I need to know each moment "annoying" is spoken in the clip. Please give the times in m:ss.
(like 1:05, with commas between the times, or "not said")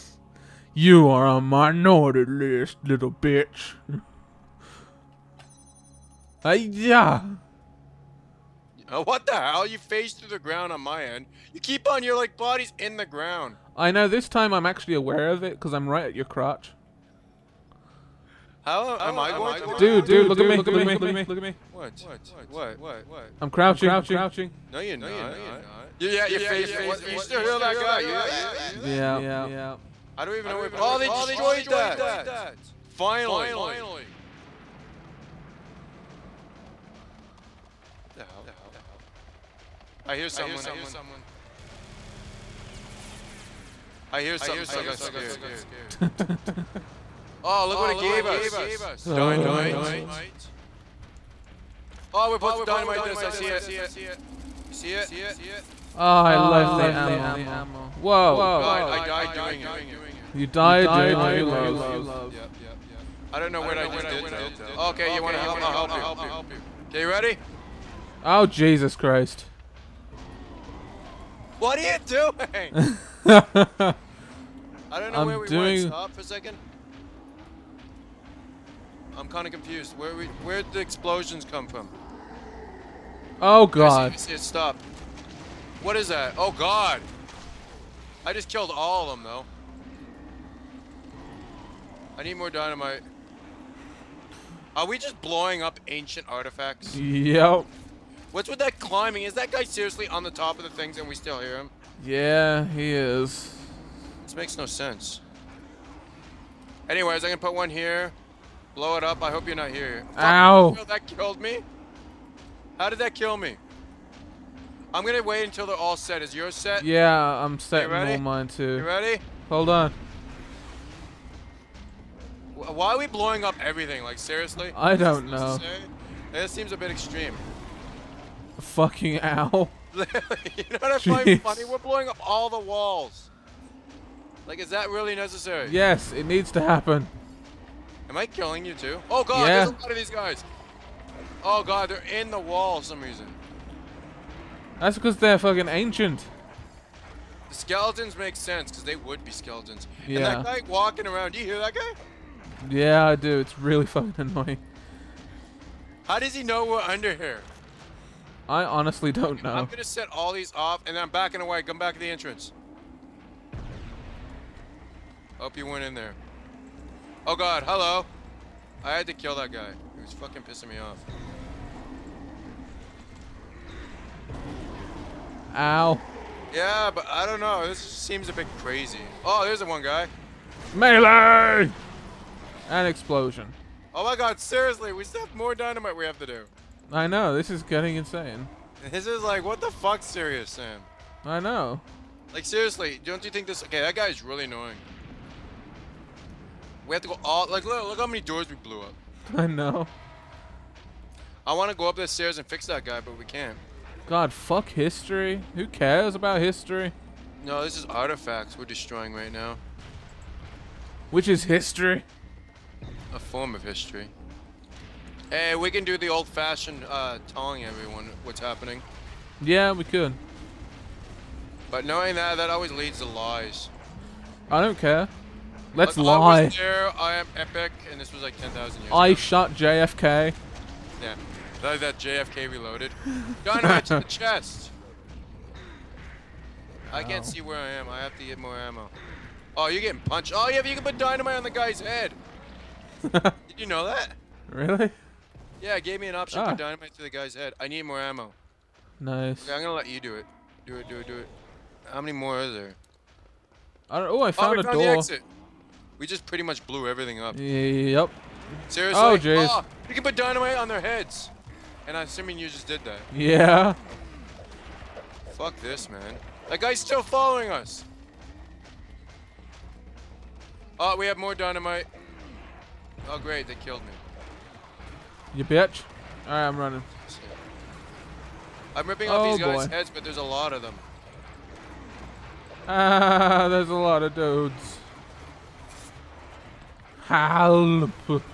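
2:34, 3:14.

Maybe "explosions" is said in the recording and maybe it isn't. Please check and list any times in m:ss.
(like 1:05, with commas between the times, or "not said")
1:20, 3:02.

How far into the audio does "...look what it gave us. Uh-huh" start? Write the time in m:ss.
0:47.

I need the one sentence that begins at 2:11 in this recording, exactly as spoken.
We're blowing up all the walls.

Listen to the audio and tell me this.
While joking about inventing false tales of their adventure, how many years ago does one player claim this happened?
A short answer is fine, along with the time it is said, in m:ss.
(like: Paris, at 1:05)
10,000, at 3:48.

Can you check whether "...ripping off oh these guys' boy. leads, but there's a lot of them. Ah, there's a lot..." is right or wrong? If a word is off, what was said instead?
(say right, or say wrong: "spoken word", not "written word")
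wrong: "heads", not "leads".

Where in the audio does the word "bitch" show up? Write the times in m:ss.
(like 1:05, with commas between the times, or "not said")
0:03, 4:35.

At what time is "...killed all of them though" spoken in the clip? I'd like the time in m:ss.
1:28.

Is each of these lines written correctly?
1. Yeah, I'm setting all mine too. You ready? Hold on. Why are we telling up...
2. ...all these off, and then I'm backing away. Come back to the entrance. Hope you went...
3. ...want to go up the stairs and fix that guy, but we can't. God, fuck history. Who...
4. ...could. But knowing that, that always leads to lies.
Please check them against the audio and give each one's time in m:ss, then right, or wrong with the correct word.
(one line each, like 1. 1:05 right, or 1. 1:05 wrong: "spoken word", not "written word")
1. 1:56 wrong: "blowing", not "telling"
2. 2:40 right
3. 3:21 right
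4. 3:39 right.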